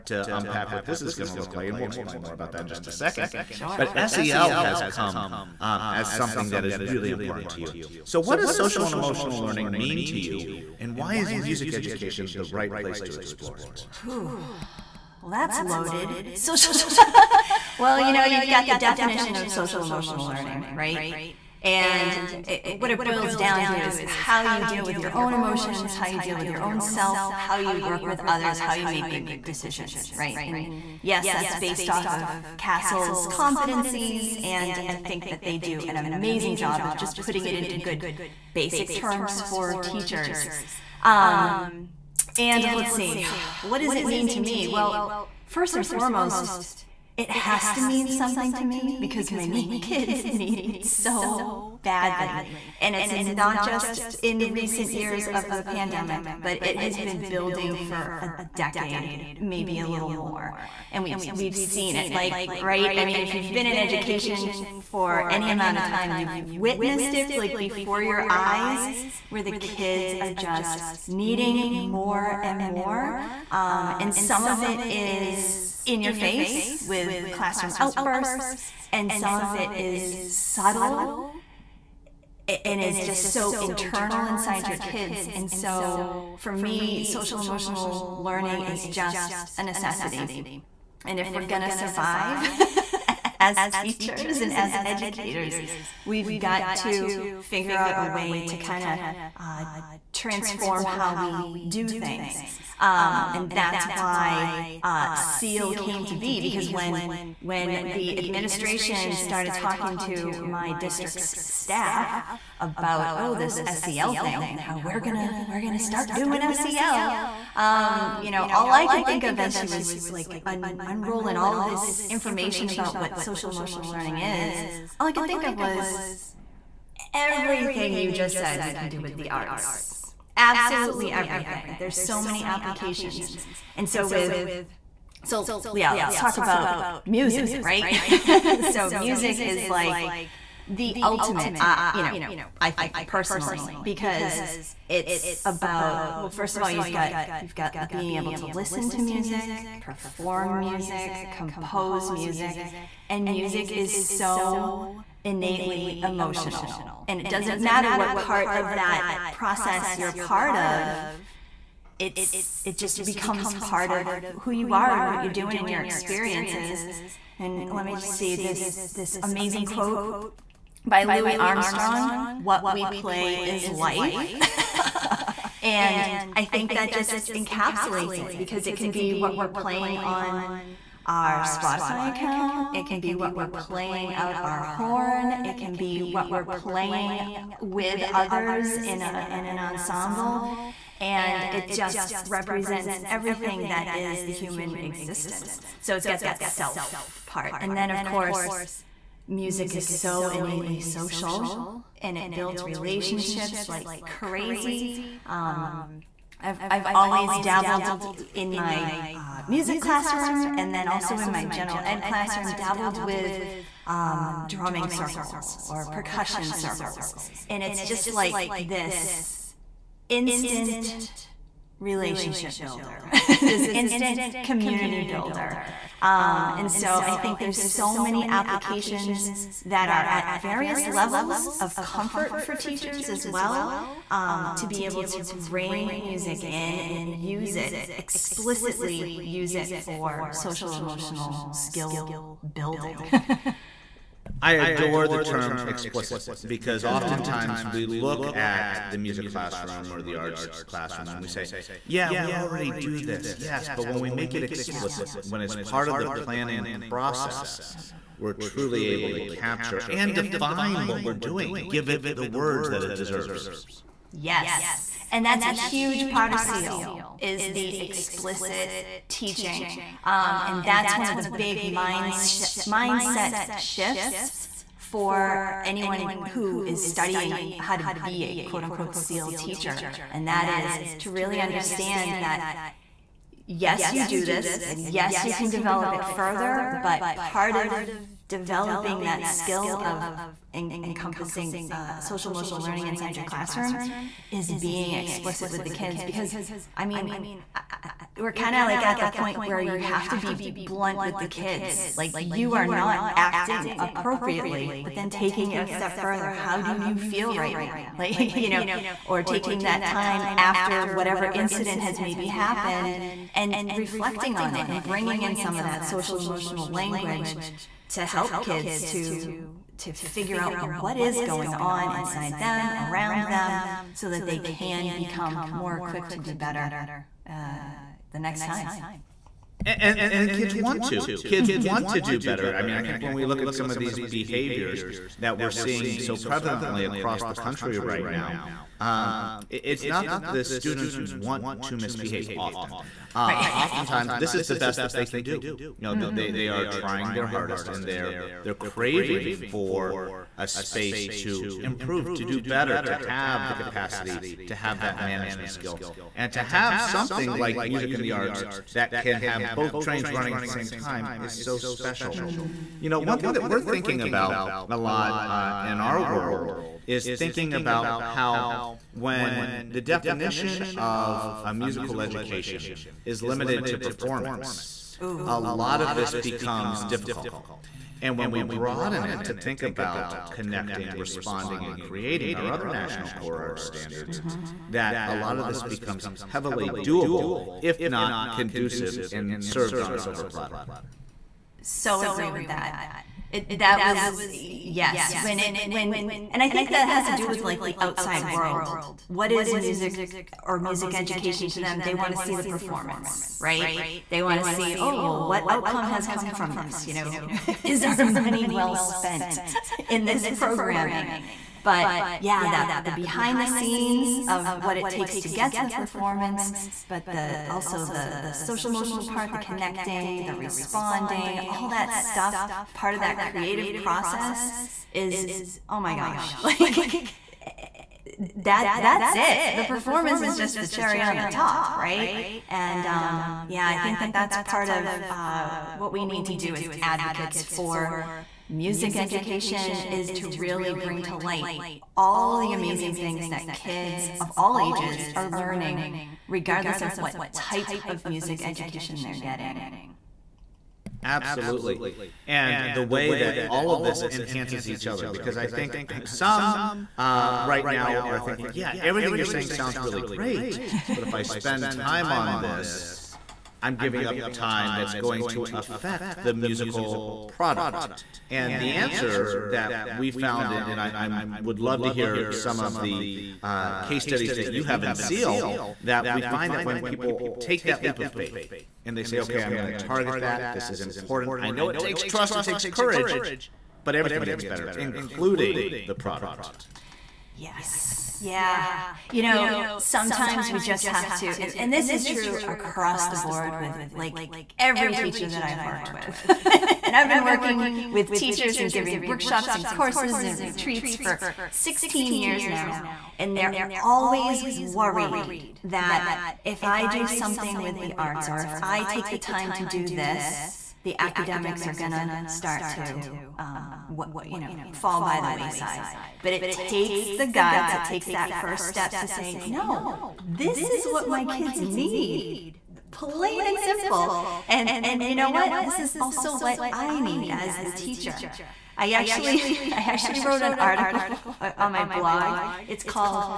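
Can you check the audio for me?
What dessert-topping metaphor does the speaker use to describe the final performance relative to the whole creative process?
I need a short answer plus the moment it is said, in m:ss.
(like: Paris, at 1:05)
cherry on the top, at 7:10.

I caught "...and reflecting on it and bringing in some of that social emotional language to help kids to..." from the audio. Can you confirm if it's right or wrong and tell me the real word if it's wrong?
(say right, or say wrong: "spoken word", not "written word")
right.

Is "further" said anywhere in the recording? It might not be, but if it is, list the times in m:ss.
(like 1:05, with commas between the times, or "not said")
4:46, 5:05.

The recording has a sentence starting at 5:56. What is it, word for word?
And to have something like music and the arts that can have both trains running at the same time is so special.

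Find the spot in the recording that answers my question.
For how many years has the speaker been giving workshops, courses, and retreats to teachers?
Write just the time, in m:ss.
8:21.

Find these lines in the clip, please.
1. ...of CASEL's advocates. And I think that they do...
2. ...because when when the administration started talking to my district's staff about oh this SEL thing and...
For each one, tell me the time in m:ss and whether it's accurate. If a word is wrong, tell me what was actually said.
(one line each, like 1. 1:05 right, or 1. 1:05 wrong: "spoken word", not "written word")
1. 0:32 wrong: "competencies", not "advocates"
2. 1:46 right.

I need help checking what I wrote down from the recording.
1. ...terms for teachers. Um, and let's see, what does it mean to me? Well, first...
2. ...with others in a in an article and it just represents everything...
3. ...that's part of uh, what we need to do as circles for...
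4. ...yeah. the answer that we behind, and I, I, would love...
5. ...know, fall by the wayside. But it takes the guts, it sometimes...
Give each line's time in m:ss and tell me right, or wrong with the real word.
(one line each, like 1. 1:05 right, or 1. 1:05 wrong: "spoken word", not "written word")
1. 0:38 right
2. 3:07 wrong: "ensemble", not "article"
3. 7:14 wrong: "advocates", not "circles"
4. 7:48 wrong: "found", not "behind"
5. 8:34 wrong: "takes", not "sometimes".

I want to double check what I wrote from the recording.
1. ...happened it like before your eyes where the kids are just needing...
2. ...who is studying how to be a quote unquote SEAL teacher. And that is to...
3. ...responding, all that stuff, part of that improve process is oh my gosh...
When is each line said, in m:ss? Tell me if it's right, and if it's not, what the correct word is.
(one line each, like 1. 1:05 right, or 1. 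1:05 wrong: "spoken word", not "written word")
1. 1:06 wrong: "witnessed", not "happened"
2. 4:36 right
3. 7:00 wrong: "creative", not "improve".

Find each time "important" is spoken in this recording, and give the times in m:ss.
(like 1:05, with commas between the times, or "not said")
0:07, 8:00.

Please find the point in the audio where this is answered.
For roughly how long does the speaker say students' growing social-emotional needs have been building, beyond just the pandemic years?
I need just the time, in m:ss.
0:58.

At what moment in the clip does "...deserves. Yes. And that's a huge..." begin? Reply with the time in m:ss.
4:22.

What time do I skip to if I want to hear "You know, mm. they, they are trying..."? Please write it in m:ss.
5:45.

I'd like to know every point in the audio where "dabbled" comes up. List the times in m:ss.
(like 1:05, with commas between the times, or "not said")
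3:27, 3:32.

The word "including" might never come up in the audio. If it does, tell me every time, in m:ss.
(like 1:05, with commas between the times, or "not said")
8:04.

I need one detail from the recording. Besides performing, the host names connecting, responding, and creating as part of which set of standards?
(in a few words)
national core art standards.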